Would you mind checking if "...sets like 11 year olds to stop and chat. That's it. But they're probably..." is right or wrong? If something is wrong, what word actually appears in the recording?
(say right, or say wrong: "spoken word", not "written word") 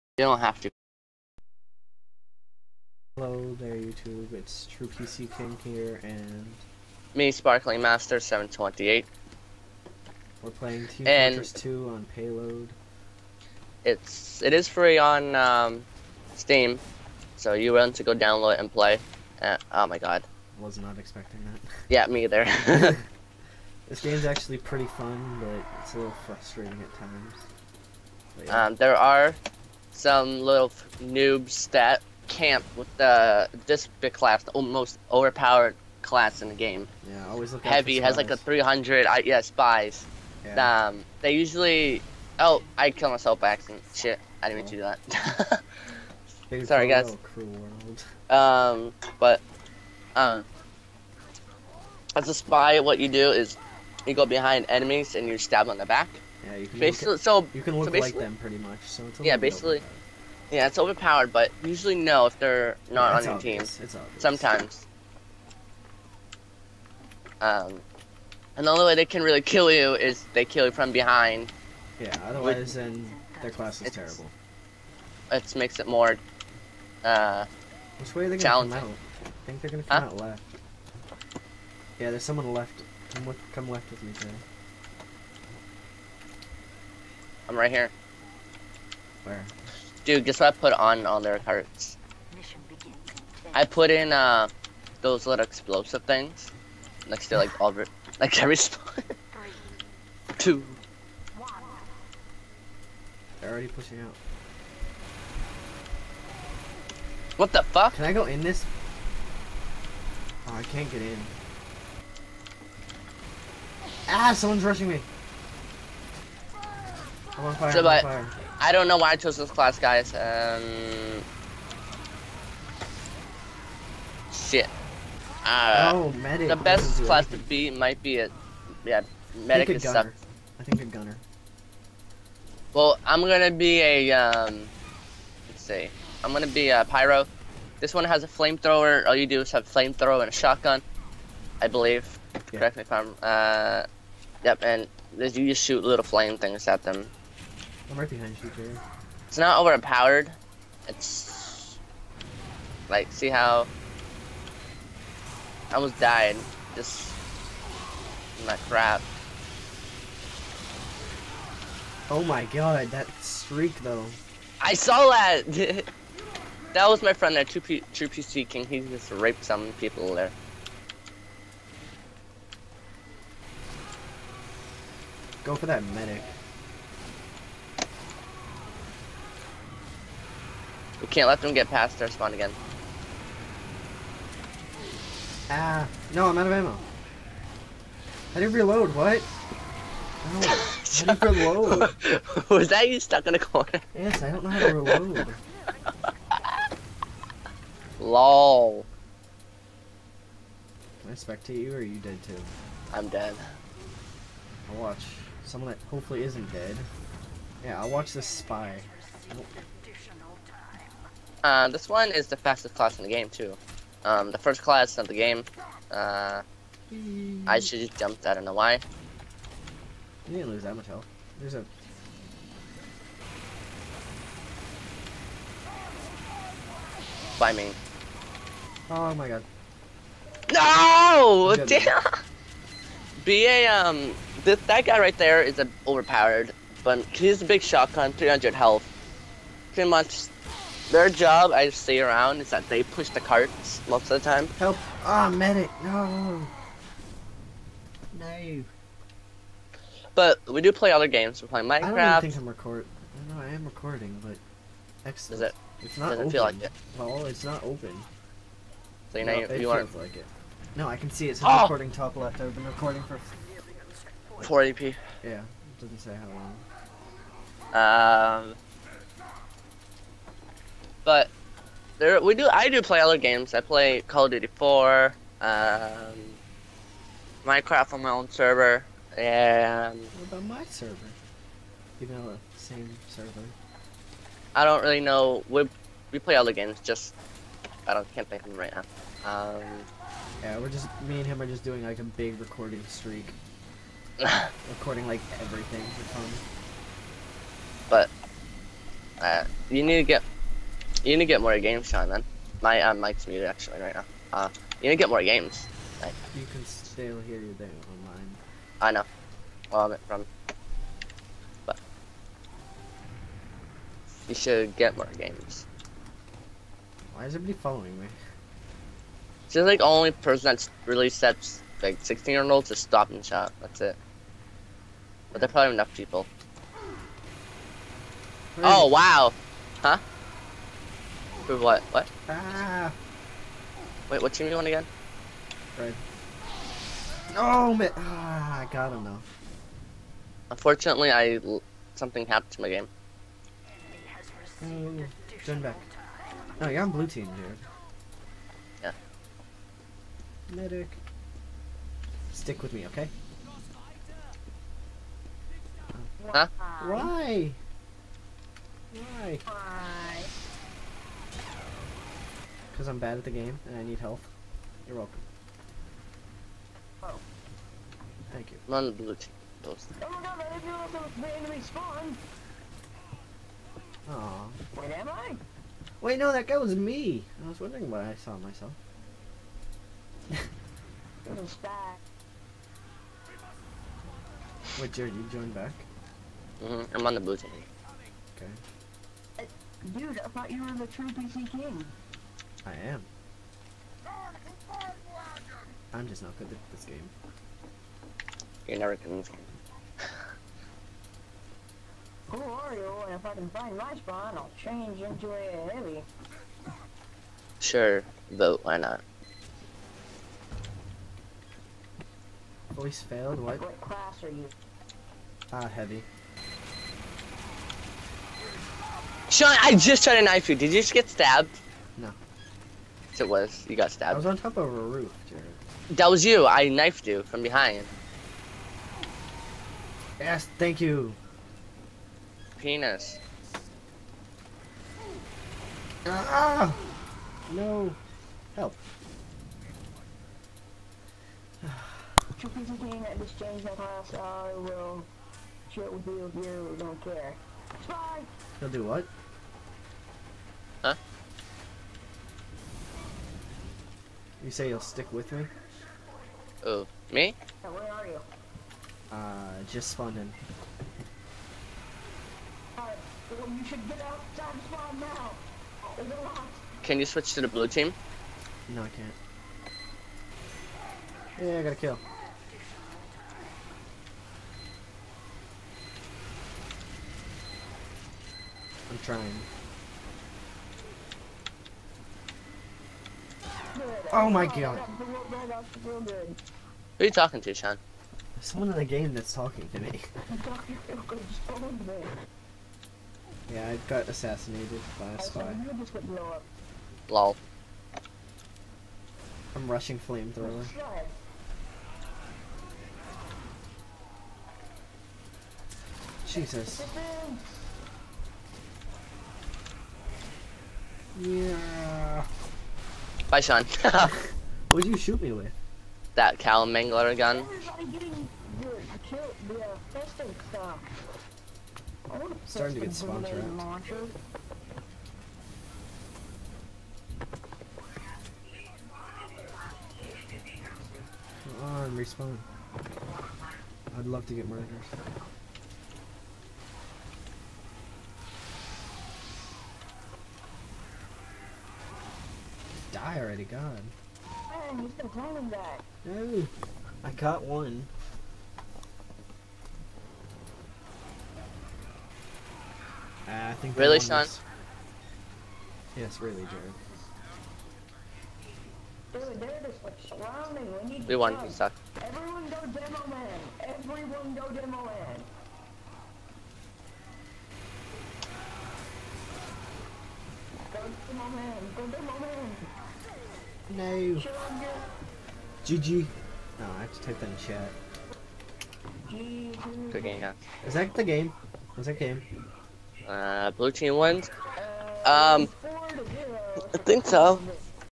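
wrong: "16", not "11".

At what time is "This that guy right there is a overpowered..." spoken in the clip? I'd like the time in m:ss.
3:54.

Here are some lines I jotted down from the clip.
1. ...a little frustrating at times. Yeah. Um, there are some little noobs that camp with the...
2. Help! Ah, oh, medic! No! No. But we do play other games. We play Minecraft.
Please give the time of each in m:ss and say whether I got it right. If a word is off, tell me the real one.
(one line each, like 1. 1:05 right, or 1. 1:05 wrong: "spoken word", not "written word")
1. 0:25 right
2. 4:04 right.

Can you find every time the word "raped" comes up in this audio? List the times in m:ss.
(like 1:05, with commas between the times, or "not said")
2:49.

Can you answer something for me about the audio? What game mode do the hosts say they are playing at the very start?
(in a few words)
Payload.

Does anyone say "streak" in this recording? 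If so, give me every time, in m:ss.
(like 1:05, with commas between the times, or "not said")
2:43, 4:52.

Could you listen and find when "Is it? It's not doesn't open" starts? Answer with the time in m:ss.
4:15.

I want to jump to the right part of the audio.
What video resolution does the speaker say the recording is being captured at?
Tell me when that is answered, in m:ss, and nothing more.
4:24.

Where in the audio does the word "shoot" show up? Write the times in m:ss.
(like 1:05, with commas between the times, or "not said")
2:25, 8:34.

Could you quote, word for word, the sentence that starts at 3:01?
We can't let them get past our spawn again.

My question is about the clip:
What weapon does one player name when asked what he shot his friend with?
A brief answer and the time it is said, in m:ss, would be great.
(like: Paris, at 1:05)
Cow Mangler, at 8:36.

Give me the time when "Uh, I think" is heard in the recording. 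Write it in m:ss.
9:13.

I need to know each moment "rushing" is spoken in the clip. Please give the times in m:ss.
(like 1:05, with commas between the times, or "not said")
1:54, 8:19.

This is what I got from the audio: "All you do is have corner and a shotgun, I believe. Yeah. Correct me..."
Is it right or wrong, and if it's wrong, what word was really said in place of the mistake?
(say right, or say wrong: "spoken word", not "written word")
wrong: "flamethrower", not "corner".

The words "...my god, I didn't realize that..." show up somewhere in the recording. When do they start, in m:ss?
6:10.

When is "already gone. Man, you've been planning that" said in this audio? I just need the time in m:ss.
9:03.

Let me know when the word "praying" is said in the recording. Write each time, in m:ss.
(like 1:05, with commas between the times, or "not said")
not said.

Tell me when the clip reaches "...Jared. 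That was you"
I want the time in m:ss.
7:05.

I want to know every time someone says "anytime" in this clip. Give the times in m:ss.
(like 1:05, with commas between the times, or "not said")
not said.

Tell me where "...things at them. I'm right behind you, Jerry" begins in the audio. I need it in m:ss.
2:26.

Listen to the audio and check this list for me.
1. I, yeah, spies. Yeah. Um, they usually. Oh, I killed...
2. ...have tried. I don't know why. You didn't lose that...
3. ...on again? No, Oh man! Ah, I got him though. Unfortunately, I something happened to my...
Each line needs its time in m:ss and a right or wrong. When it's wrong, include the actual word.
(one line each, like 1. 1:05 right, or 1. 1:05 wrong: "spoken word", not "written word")
1. 0:39 right
2. 3:37 wrong: "jumped", not "tried"
3. 5:34 right.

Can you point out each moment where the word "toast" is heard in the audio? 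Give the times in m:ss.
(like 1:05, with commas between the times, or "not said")
6:09.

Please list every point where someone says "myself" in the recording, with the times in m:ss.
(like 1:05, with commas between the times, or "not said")
0:43, 6:18.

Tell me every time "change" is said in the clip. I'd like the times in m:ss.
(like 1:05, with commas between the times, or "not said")
6:44, 7:23.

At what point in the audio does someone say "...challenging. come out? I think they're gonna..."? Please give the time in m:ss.
1:18.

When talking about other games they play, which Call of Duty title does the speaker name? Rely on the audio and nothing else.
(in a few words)
Call of Duty 4.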